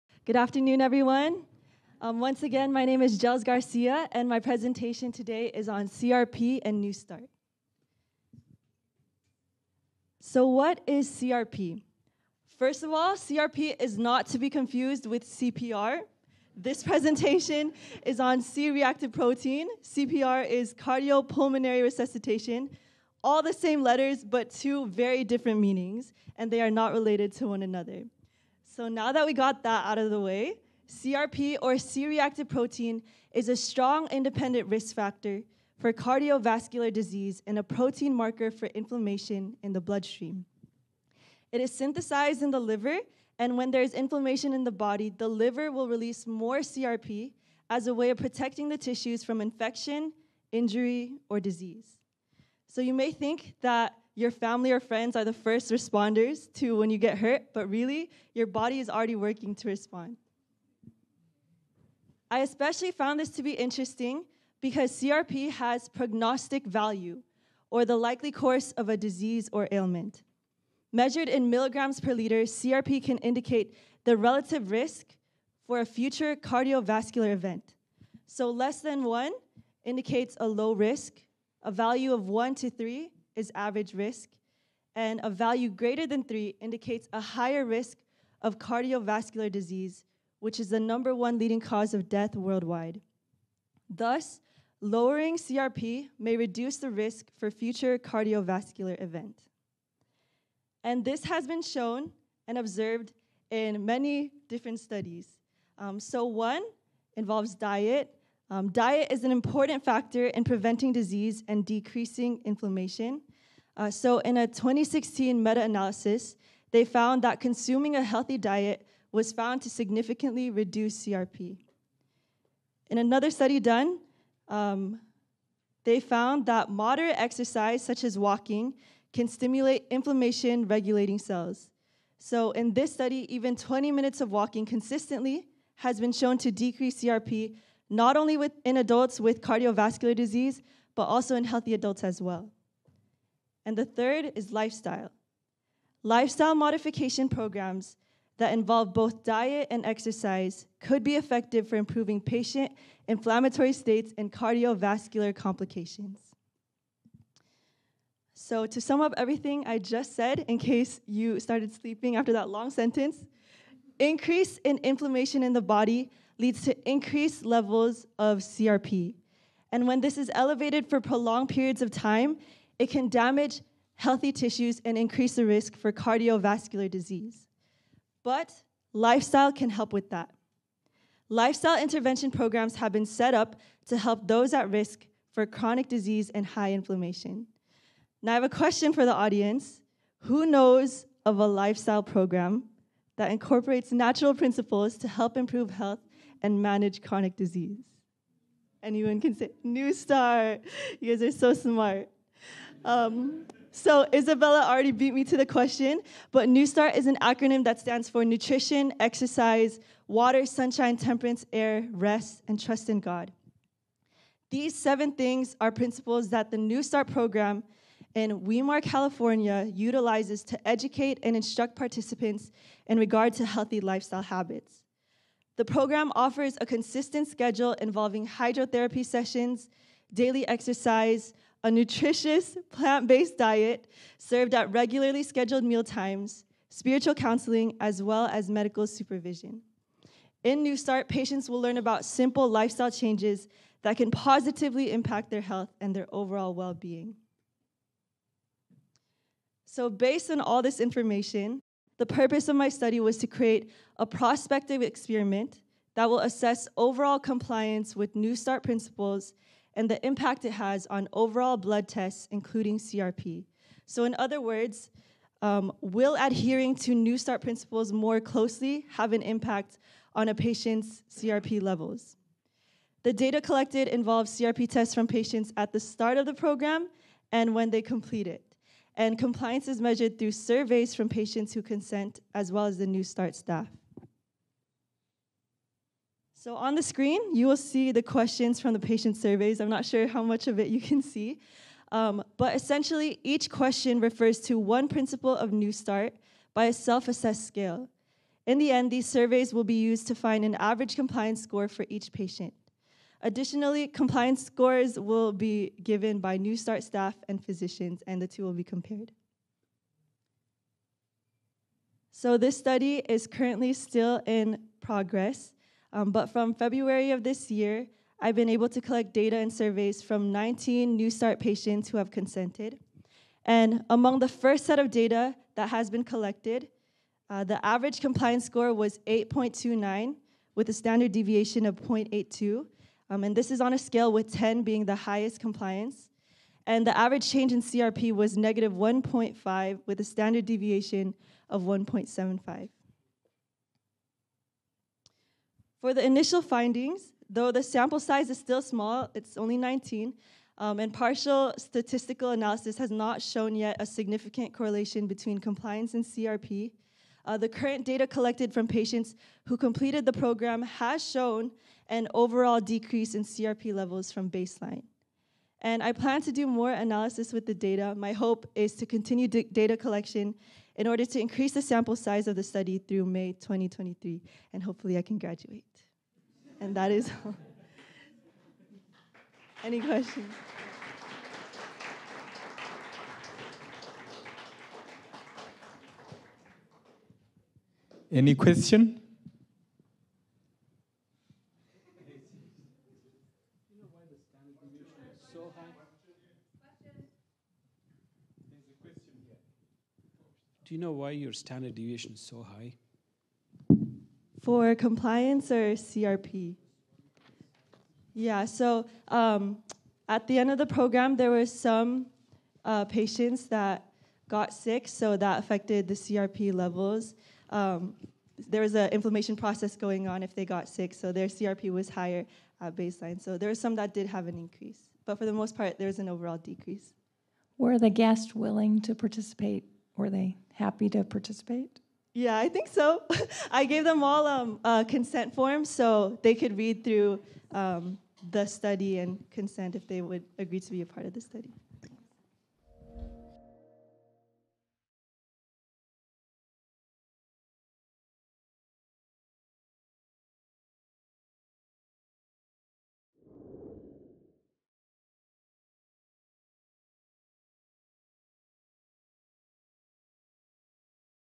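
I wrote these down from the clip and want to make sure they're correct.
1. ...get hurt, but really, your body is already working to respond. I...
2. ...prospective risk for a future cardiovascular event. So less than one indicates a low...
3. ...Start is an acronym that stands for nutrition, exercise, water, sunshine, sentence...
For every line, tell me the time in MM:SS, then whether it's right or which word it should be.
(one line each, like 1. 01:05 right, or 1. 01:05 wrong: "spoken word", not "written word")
1. 00:56 right
2. 01:14 wrong: "relative", not "prospective"
3. 03:26 wrong: "temperance", not "sentence".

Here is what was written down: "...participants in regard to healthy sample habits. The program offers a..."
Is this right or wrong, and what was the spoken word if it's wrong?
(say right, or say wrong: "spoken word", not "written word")
wrong: "lifestyle", not "sample".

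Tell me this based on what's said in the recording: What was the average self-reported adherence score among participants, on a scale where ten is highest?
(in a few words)
8.29.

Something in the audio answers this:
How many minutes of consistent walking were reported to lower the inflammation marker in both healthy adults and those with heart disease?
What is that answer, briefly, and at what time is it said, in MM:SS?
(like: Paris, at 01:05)
20, at 02:13.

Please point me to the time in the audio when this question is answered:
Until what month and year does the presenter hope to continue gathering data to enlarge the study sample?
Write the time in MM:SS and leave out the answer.
06:13.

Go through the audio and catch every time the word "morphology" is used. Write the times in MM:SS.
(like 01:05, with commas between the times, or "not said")
not said.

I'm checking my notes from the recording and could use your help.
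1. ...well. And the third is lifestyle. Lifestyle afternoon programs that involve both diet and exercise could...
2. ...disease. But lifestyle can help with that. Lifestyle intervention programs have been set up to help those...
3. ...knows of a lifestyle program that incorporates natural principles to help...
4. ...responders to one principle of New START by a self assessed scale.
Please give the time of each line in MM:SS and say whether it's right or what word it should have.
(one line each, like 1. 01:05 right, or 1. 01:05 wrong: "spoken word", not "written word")
1. 02:22 wrong: "modification", not "afternoon"
2. 02:56 right
3. 03:10 right
4. 04:53 wrong: "refers", not "responders".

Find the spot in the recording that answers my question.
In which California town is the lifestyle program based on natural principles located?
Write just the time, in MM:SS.
03:38.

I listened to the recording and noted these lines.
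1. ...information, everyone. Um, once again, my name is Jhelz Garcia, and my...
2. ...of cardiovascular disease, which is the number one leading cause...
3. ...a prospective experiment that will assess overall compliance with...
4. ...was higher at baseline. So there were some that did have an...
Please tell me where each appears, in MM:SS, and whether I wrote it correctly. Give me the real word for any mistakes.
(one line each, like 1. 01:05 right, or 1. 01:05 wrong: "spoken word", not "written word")
1. 00:00 wrong: "afternoon", not "information"
2. 01:28 right
3. 04:13 right
4. 07:01 right.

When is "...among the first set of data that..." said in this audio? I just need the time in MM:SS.
05:23.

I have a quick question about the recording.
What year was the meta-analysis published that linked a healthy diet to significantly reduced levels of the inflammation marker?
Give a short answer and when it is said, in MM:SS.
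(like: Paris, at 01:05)
2016, at 01:54.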